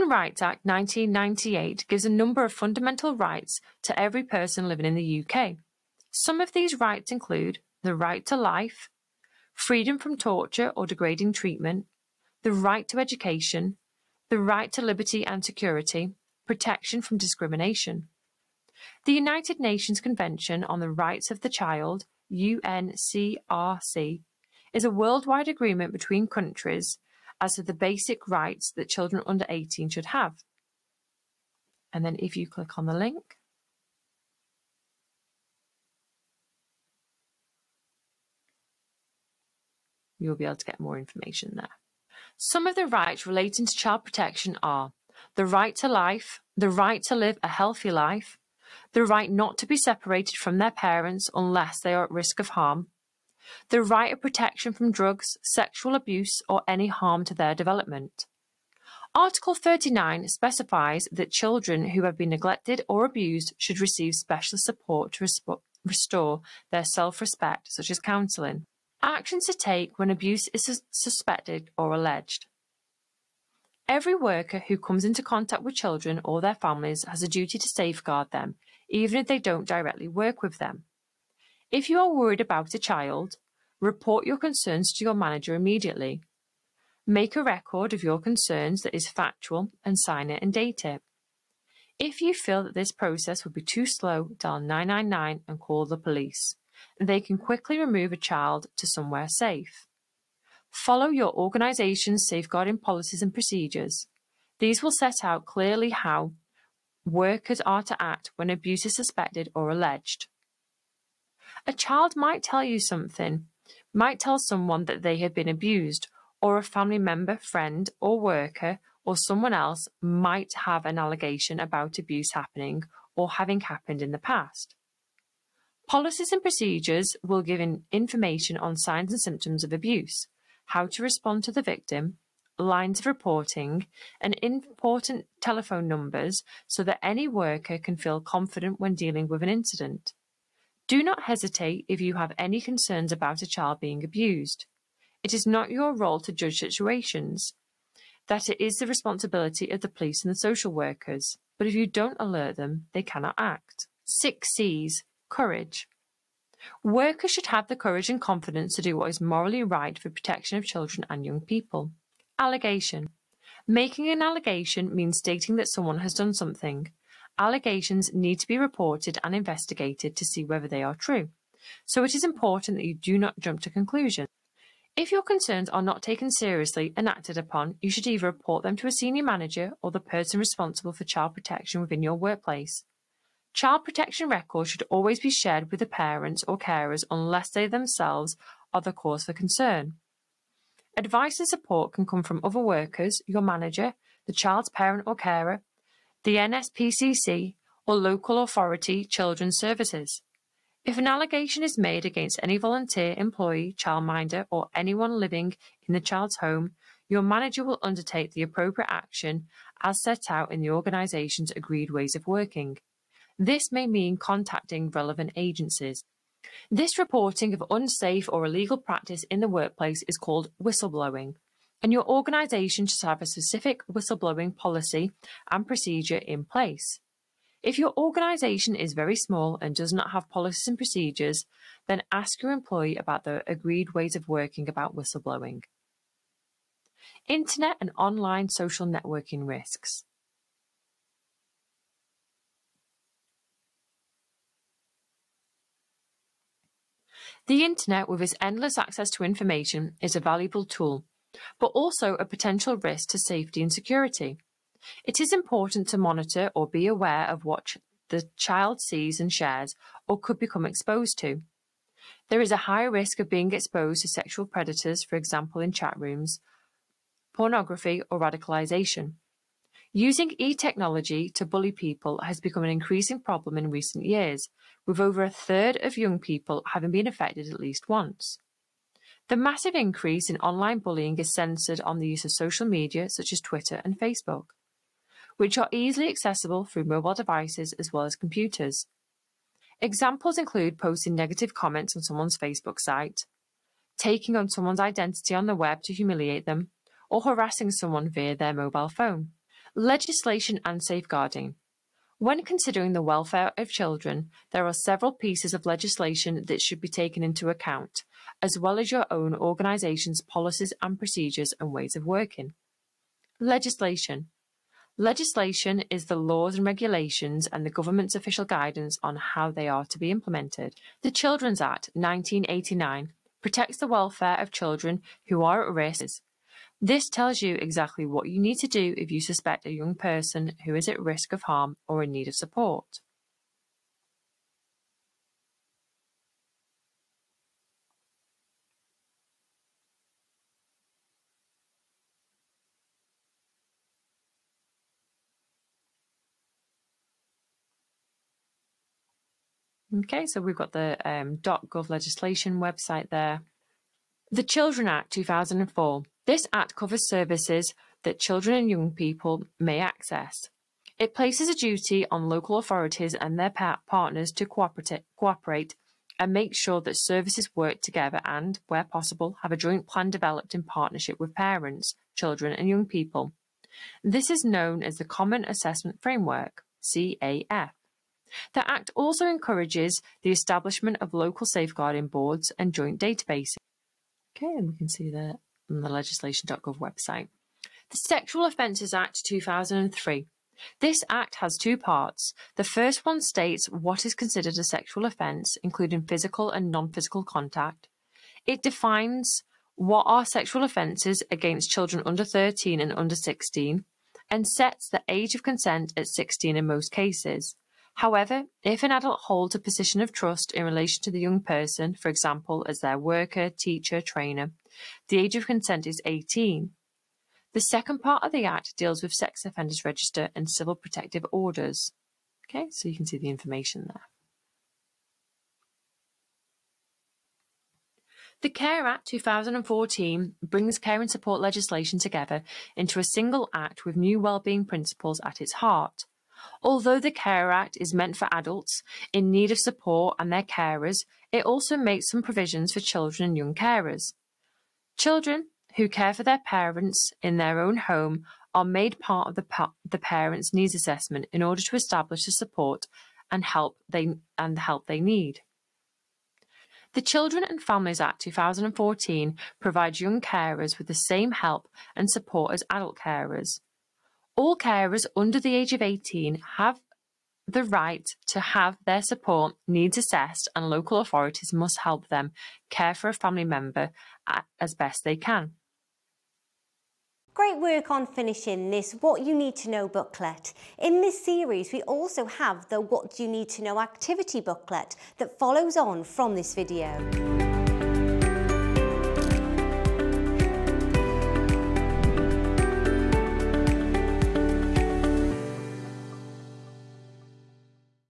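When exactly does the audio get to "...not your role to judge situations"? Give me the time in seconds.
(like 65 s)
145 s.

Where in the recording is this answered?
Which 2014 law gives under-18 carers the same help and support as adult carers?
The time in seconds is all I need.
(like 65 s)
456 s.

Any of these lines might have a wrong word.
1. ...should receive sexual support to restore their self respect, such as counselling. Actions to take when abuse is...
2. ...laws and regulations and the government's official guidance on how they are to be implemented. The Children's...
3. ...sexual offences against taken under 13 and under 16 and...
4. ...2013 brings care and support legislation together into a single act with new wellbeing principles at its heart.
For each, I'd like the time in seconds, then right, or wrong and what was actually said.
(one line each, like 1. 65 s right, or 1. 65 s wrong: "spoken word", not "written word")
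1. 63 s wrong: "special", not "sexual"
2. 316 s right
3. 400 s wrong: "children", not "taken"
4. 429 s wrong: "2014", not "2013".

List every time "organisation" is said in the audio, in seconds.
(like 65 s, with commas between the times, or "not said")
101 s, 210 s, 222 s, 227 s, 309 s.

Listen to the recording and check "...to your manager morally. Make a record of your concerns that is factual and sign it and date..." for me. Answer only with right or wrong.
wrong.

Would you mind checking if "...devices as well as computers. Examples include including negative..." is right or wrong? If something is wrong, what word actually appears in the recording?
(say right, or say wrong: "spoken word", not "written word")
wrong: "posting", not "including".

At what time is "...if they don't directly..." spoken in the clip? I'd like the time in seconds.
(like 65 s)
79 s.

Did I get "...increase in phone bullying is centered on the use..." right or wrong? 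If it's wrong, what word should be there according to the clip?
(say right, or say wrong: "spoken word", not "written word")
wrong: "online", not "phone".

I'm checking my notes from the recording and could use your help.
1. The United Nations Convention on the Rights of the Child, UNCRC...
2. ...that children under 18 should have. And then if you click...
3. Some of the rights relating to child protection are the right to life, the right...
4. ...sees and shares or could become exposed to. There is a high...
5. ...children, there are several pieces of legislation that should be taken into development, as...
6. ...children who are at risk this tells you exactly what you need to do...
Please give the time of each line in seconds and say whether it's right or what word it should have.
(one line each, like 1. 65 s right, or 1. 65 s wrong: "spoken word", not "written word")
1. 19 s right
2. 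28 s right
3. 42 s right
4. 258 s right
5. 303 s wrong: "account", not "development"
6. 324 s right.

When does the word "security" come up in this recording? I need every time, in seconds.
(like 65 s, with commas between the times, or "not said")
15 s, 253 s.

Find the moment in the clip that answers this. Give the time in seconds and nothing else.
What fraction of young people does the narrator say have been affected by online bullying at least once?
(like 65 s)
274 s.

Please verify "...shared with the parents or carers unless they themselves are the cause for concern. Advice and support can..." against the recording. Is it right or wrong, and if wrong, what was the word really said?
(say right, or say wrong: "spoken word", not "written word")
right.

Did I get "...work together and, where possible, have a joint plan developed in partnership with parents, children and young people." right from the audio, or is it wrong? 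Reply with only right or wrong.
right.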